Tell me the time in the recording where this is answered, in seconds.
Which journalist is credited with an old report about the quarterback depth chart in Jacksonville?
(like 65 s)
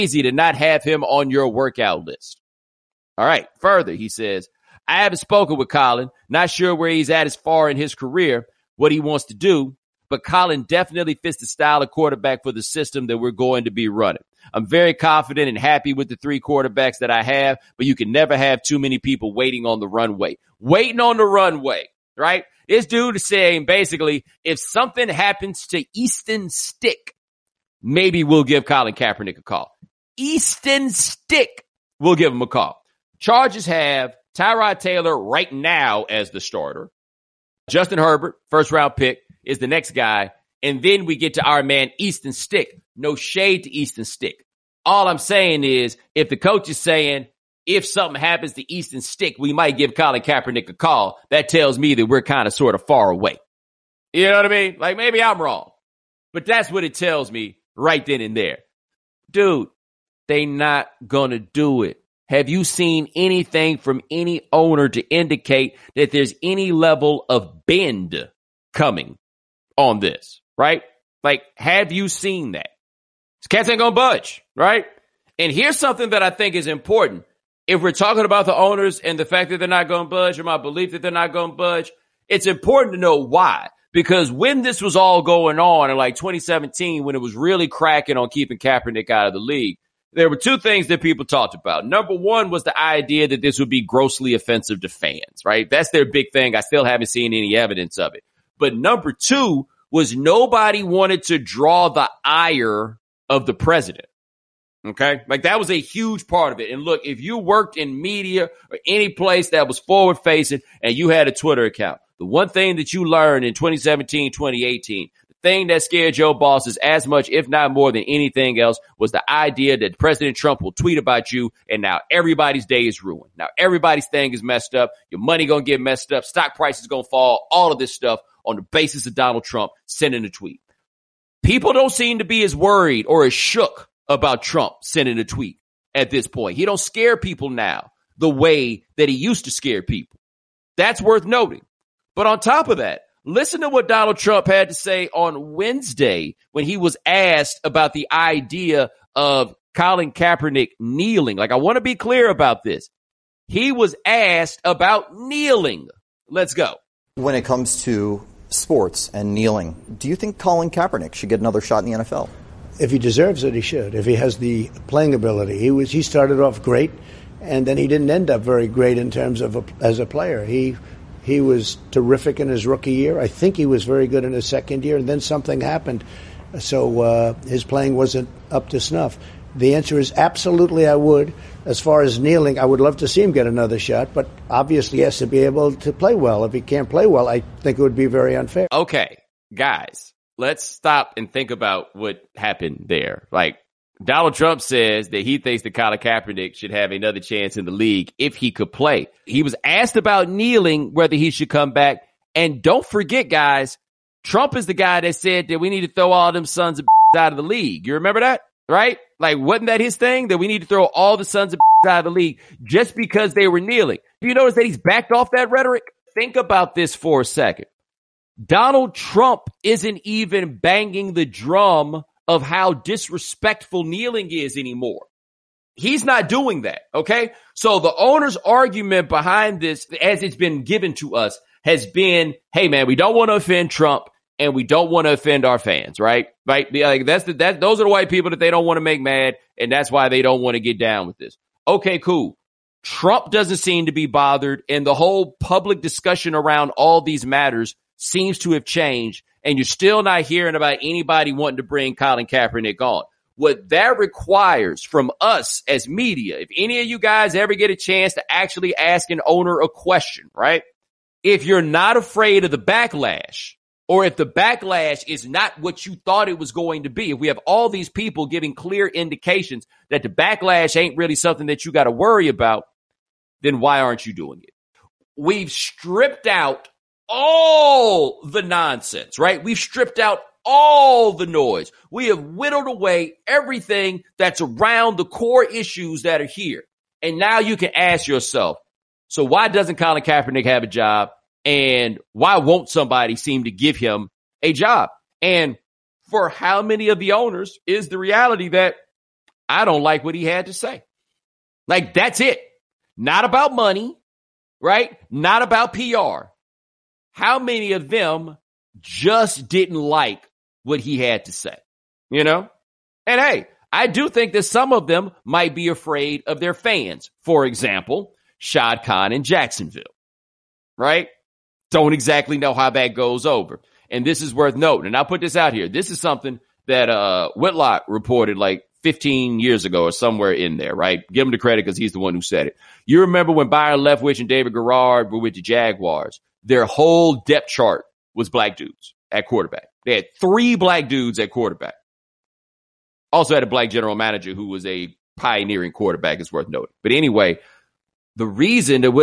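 327 s.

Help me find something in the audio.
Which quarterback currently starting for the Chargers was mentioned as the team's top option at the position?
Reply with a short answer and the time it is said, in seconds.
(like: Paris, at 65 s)
Tyrod Taylor, at 34 s.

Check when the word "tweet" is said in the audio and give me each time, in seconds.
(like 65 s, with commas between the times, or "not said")
120 s, 130 s, 135 s.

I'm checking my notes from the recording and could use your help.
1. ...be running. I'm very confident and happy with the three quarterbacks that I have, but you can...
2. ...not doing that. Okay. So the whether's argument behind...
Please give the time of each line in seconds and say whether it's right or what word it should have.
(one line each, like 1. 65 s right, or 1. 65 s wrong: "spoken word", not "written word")
1. 13 s right
2. 226 s wrong: "owner", not "whether".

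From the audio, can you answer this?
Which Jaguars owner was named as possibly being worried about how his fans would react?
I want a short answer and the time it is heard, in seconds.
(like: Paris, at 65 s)
Shad Khan, at 318 s.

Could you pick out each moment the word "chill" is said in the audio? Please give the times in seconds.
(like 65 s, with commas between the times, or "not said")
not said.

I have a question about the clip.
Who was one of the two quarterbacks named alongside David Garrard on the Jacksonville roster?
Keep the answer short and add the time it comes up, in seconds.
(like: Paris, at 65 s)
Byron Leftwich, at 333 s.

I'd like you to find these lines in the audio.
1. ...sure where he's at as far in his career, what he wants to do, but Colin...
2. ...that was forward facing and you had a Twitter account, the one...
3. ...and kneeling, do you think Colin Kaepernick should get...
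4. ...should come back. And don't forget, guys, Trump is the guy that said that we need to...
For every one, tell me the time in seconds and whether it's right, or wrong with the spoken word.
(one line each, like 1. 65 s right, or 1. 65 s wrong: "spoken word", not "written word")
1. 6 s right
2. 109 s right
3. 159 s right
4. 201 s right.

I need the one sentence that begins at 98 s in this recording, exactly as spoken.
But number two was nobody wanted to draw the ire of the president.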